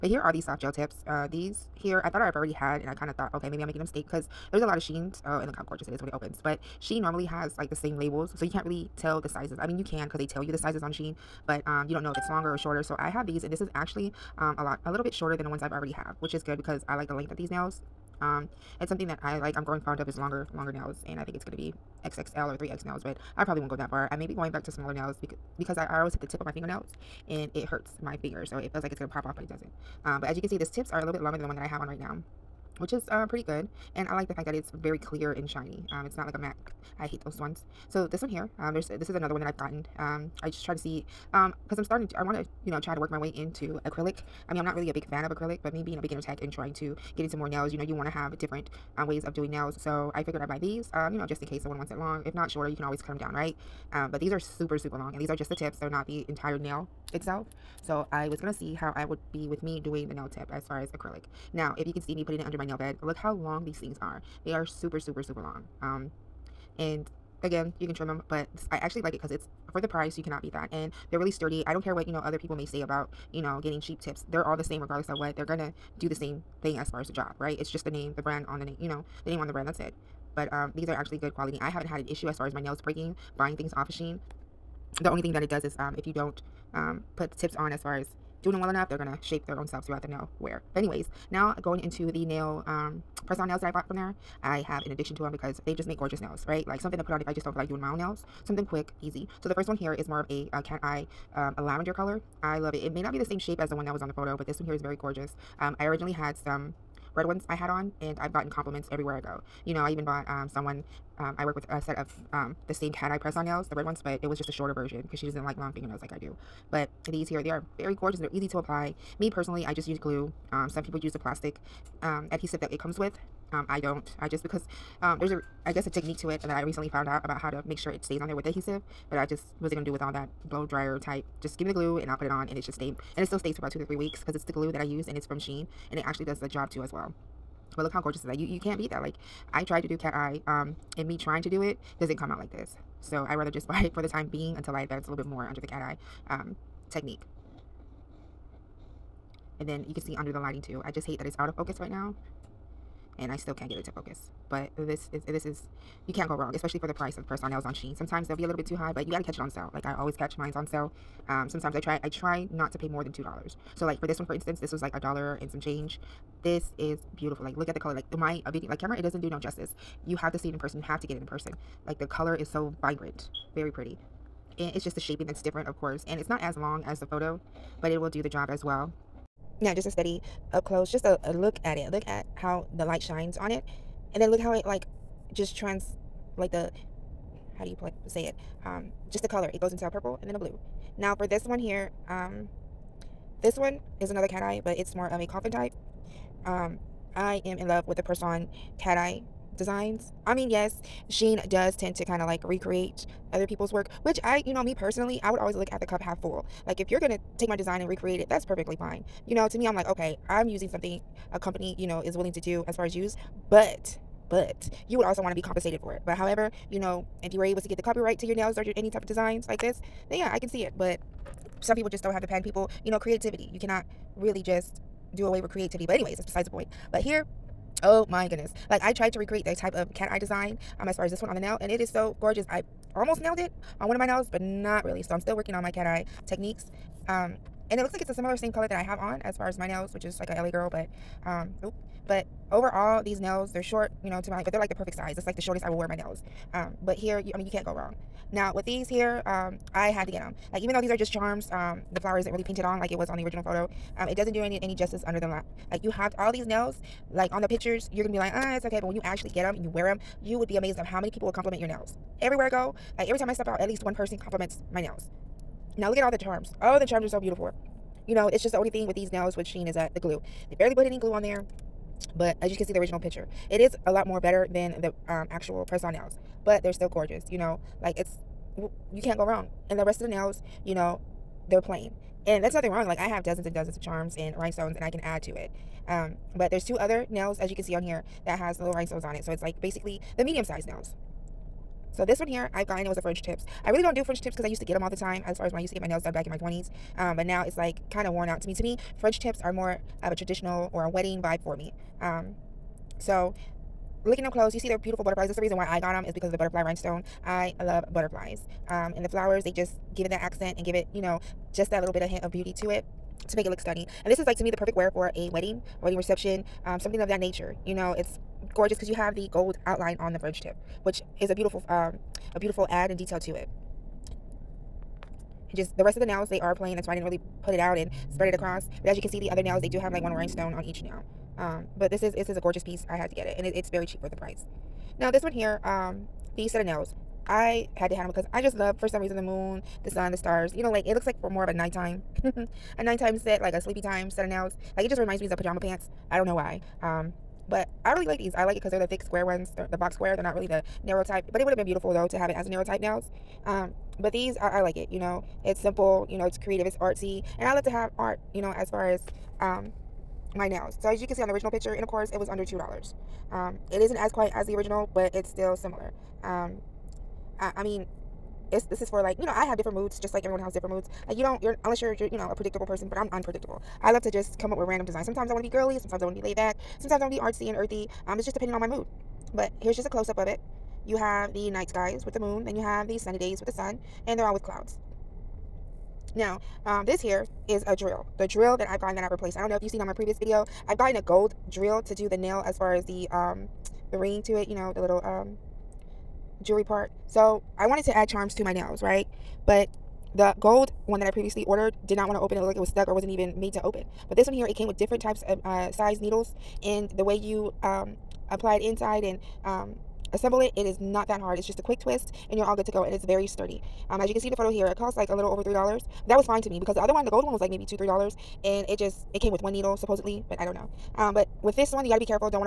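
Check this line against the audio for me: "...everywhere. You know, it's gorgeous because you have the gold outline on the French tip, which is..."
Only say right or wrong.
wrong.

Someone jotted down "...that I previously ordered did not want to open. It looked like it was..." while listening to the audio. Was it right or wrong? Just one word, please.
right.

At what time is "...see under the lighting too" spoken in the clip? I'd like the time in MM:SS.
02:30.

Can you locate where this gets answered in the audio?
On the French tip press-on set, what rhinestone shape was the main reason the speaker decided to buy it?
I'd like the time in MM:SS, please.
05:06.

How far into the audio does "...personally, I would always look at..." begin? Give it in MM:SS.
03:24.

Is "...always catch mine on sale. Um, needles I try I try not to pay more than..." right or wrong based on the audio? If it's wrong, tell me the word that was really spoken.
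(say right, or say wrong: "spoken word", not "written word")
wrong: "sometimes", not "needles".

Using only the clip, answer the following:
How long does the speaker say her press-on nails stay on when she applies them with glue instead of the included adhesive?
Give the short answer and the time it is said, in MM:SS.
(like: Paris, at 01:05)
2 to 3 weeks, at 02:13.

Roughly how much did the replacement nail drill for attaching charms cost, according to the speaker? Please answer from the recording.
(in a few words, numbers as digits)
A little over 3 dollars.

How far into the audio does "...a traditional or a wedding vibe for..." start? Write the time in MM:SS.
05:00.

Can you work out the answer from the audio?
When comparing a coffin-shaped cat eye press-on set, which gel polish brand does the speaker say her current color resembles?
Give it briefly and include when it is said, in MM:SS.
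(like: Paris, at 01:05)
LA Girl, at 04:00.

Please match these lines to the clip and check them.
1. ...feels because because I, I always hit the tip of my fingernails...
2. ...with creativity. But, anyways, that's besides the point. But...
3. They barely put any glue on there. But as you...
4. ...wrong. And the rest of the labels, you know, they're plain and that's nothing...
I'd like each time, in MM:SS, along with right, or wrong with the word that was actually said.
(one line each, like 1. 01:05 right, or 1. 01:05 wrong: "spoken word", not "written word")
1. 00:24 wrong: "nails", not "feels"
2. 03:45 right
3. 04:30 right
4. 04:39 wrong: "nails", not "labels".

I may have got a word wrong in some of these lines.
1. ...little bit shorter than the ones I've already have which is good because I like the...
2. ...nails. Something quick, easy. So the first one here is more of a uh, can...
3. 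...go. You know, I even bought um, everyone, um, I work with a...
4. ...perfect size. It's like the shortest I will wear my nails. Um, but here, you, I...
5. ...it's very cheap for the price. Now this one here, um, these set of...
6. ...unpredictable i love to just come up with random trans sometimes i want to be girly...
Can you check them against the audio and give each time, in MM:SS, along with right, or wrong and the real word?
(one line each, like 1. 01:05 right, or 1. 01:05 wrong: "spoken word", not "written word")
1. 00:14 right
2. 01:37 right
3. 01:49 wrong: "someone", not "everyone"
4. 04:04 right
5. 05:33 right
6. 06:13 wrong: "designs", not "trans".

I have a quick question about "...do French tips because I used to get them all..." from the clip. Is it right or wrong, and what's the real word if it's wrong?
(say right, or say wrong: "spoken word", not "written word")
right.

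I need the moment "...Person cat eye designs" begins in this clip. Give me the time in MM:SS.
03:18.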